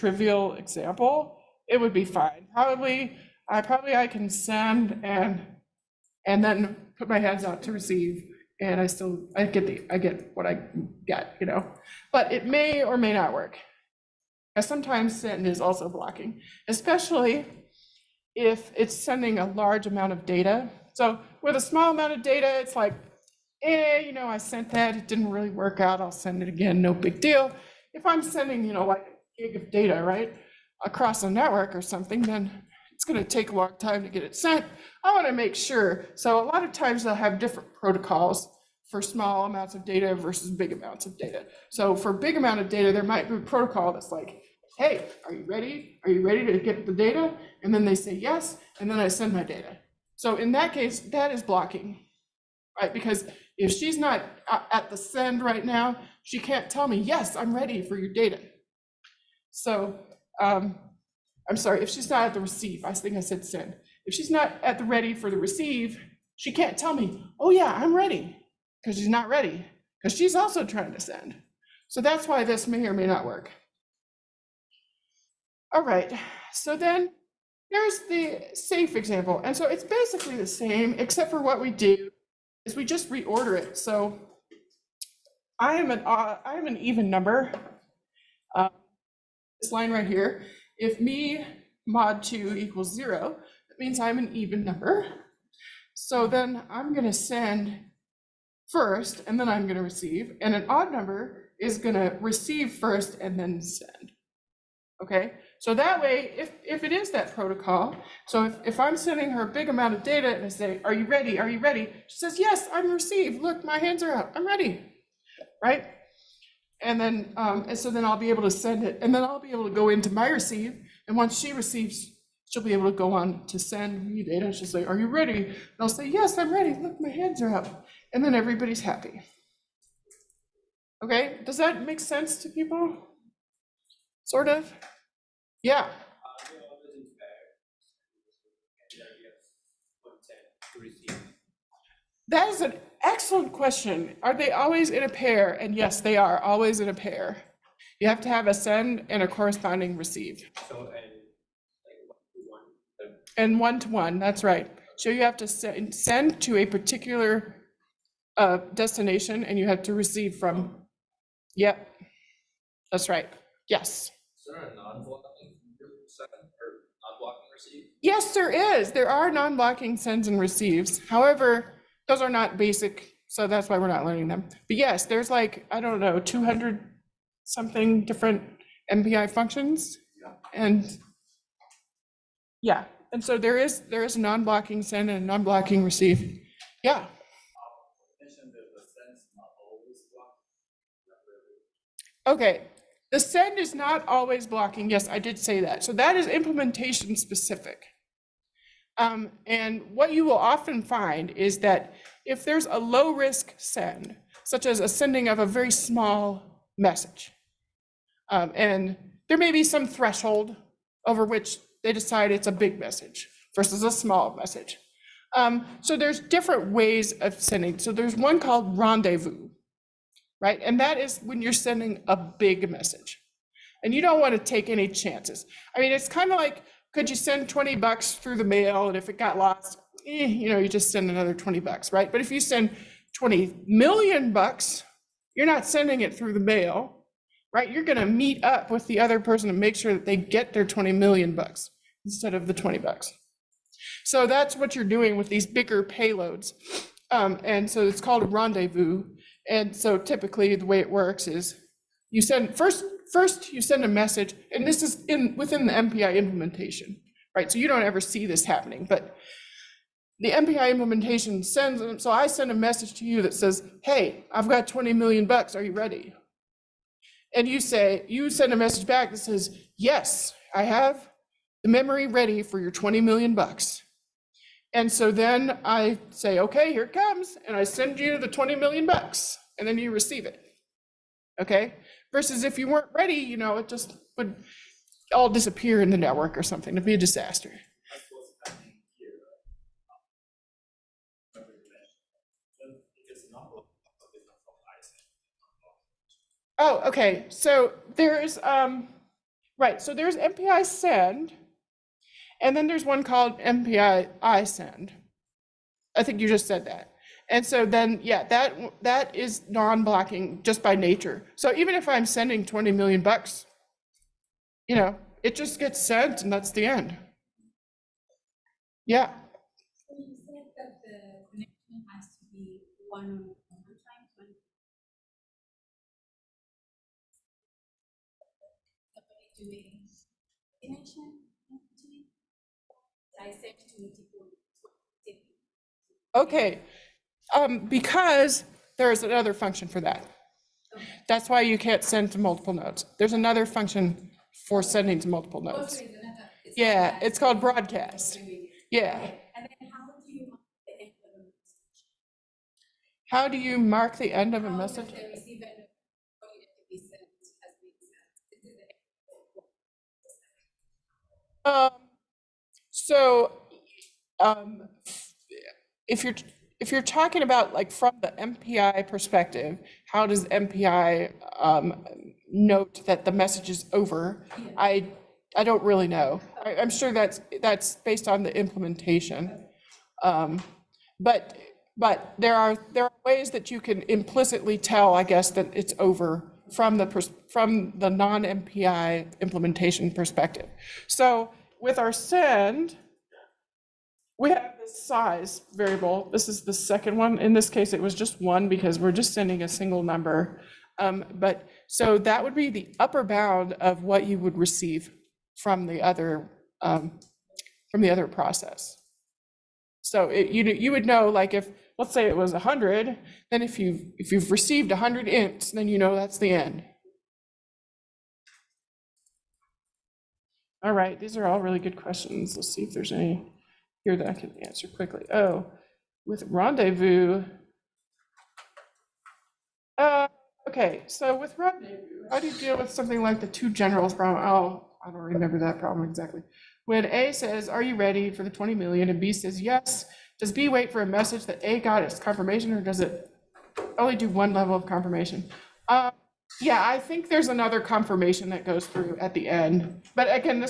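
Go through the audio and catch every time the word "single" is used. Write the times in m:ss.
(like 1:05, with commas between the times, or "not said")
6:39.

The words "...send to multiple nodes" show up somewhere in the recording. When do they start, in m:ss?
5:41.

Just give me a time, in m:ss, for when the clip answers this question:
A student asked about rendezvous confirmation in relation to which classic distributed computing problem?
7:13.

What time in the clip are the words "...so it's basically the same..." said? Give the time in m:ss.
1:19.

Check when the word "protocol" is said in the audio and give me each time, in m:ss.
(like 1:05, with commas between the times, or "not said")
0:37, 0:43, 1:47.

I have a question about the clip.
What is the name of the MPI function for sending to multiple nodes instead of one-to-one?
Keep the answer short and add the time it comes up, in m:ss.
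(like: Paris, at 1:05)
broadcast, at 5:47.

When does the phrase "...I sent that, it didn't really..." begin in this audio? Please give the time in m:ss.
0:24.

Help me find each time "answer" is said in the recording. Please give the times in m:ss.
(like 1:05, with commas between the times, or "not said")
7:04.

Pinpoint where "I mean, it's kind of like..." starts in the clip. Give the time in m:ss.
3:45.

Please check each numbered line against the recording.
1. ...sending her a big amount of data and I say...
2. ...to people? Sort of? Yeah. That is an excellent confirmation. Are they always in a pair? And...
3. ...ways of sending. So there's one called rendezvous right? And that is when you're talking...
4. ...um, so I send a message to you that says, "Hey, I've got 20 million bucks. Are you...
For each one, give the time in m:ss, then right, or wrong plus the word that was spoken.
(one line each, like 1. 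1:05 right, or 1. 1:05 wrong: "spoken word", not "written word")
1. 1:48 right
2. 2:12 wrong: "question", not "confirmation"
3. 3:36 wrong: "sending", not "talking"
4. 4:21 right.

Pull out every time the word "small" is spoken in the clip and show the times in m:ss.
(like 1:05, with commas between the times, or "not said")
0:21, 0:39, 3:25, 3:33.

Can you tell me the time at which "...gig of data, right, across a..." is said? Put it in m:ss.
0:29.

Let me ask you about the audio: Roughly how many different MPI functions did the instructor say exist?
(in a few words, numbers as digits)
200 something.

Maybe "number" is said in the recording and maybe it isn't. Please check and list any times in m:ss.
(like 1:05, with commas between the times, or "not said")
1:27, 1:34, 1:40, 6:39.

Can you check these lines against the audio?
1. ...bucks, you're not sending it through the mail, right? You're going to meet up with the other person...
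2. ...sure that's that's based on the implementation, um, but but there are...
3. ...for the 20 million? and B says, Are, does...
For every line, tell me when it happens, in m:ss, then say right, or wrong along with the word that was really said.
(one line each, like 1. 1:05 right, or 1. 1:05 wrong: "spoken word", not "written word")
1. 3:54 right
2. 6:16 right
3. 7:18 wrong: "Yes", not "Are".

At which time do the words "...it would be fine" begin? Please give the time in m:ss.
0:01.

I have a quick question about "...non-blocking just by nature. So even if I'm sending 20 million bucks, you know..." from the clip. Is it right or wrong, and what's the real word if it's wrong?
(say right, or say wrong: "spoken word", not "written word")
right.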